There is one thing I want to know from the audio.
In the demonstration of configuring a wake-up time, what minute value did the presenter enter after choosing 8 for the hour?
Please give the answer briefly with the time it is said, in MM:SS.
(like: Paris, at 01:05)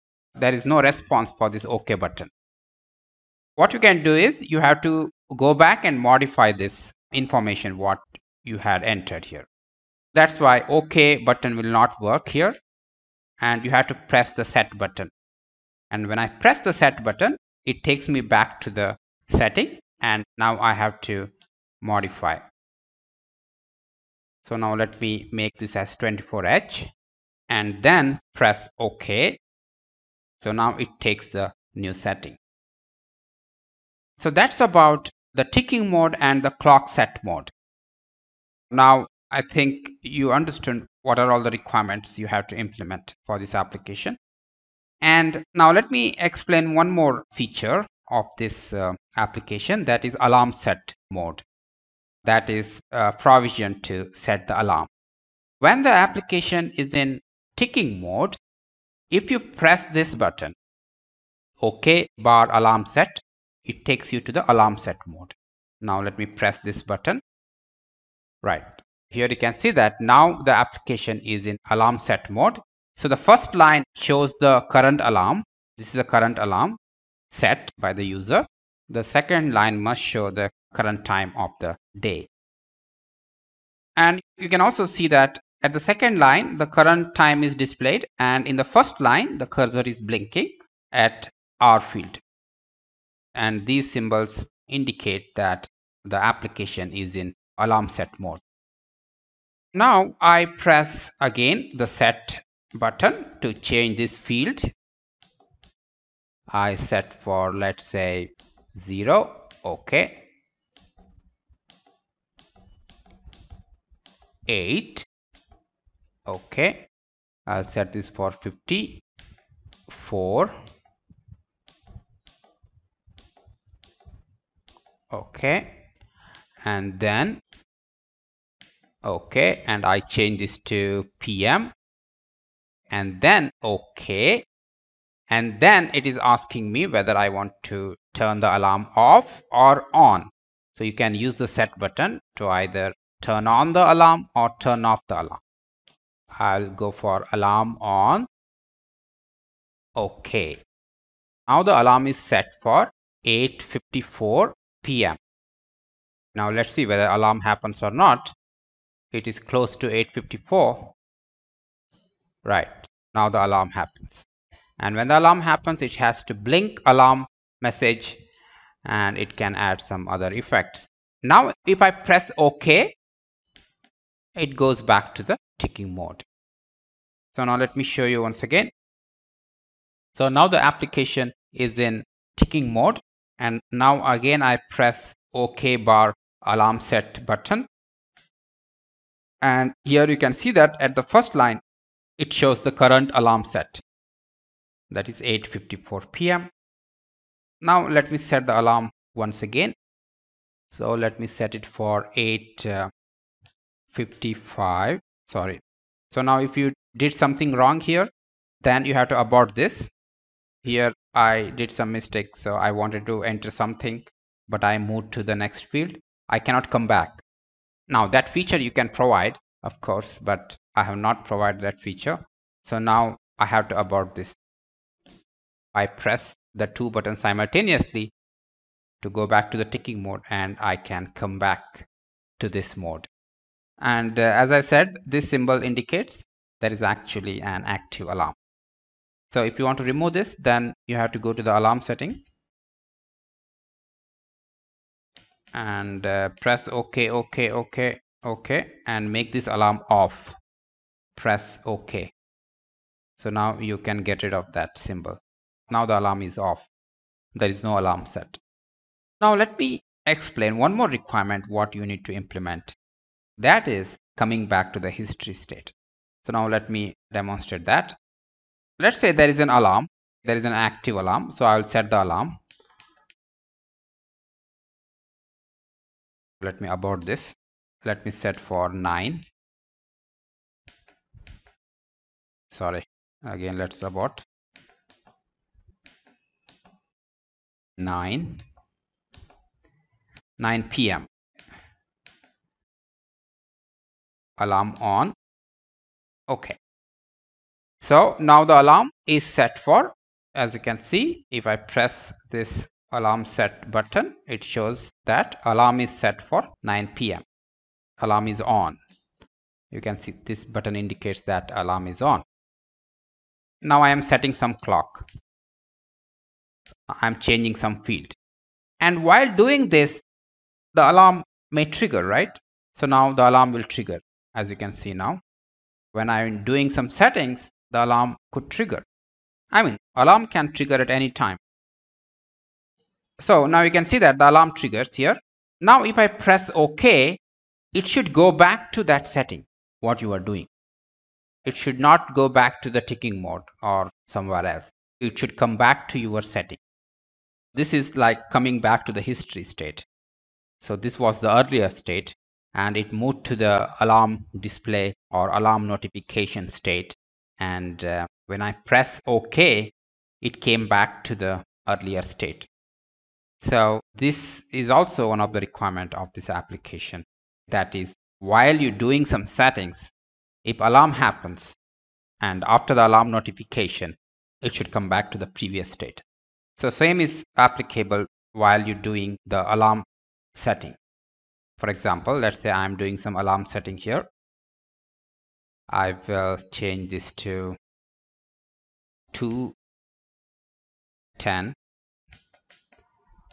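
54, at 01:58.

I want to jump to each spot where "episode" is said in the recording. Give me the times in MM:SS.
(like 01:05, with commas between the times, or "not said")
not said.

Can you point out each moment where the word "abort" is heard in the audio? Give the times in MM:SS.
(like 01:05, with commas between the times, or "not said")
03:29, 03:43, 04:36, 04:43.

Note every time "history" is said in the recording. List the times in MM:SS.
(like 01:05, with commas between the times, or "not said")
04:24, 05:49.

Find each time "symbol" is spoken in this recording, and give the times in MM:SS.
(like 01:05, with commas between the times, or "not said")
01:33, 03:55, 04:14.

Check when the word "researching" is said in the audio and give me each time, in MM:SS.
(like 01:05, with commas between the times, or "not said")
not said.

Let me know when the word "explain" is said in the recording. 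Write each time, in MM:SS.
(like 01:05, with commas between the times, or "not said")
00:46, 04:20.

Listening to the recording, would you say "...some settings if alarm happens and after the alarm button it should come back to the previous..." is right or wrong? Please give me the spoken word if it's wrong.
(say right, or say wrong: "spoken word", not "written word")
wrong: "notification", not "button".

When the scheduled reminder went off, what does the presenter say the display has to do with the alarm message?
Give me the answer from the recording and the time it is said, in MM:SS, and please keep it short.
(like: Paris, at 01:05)
blink, at 02:46.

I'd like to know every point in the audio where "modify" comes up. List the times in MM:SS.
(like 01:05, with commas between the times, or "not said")
00:05, 00:21.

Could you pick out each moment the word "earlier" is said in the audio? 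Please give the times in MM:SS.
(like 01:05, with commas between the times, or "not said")
05:51, 06:01.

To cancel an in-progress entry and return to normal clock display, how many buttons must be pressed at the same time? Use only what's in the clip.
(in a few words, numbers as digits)
2.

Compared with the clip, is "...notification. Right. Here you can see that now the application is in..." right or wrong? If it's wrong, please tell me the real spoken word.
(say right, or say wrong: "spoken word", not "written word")
wrong: "button", not "notification".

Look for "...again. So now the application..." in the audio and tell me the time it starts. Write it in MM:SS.
02:58.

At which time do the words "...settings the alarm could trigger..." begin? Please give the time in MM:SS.
05:26.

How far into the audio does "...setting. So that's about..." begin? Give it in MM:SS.
00:31.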